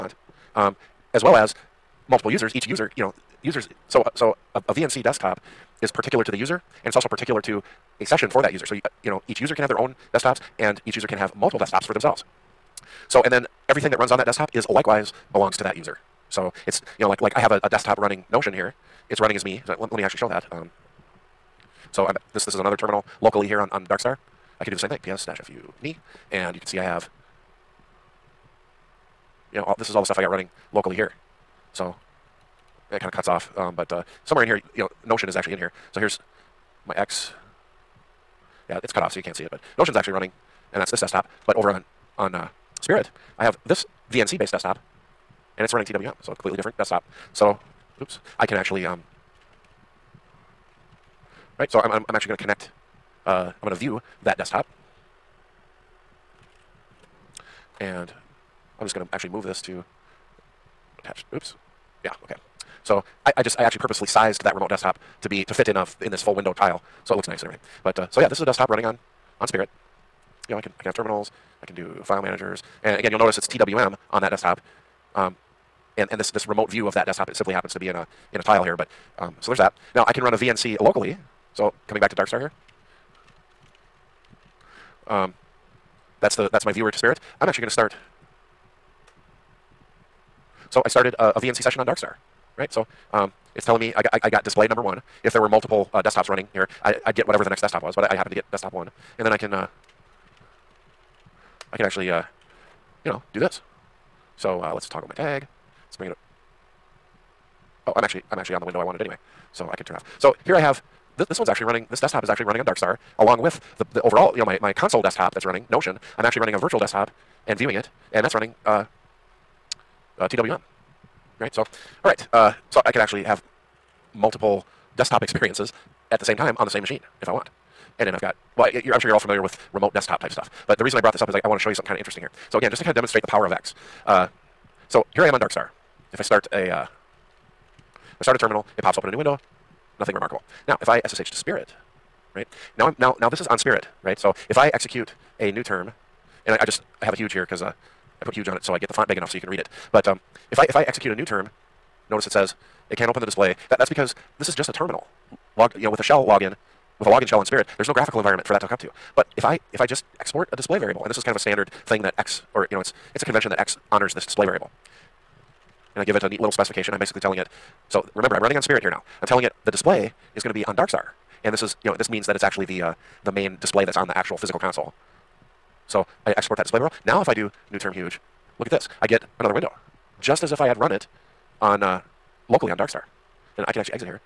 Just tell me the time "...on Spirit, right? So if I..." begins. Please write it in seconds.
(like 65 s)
143 s.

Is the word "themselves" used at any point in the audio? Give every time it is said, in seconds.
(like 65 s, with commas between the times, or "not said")
11 s.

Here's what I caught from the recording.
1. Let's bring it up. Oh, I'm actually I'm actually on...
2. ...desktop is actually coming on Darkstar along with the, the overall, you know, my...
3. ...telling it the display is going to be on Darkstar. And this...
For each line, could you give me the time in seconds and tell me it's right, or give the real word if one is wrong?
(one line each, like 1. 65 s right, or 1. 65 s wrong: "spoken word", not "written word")
1. 105 s right
2. 112 s wrong: "running", not "coming"
3. 169 s right.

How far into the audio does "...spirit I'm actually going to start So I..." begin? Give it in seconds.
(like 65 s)
86 s.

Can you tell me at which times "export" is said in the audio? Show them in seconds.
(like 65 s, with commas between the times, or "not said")
160 s, 176 s.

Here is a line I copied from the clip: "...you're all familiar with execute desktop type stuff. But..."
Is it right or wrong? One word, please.
wrong.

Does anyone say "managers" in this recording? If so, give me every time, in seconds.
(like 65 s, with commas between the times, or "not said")
72 s.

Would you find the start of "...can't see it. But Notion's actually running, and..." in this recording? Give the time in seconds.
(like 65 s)
39 s.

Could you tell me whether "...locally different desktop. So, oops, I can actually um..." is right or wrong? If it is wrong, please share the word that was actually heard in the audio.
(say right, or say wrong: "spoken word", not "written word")
wrong: "completely", not "locally".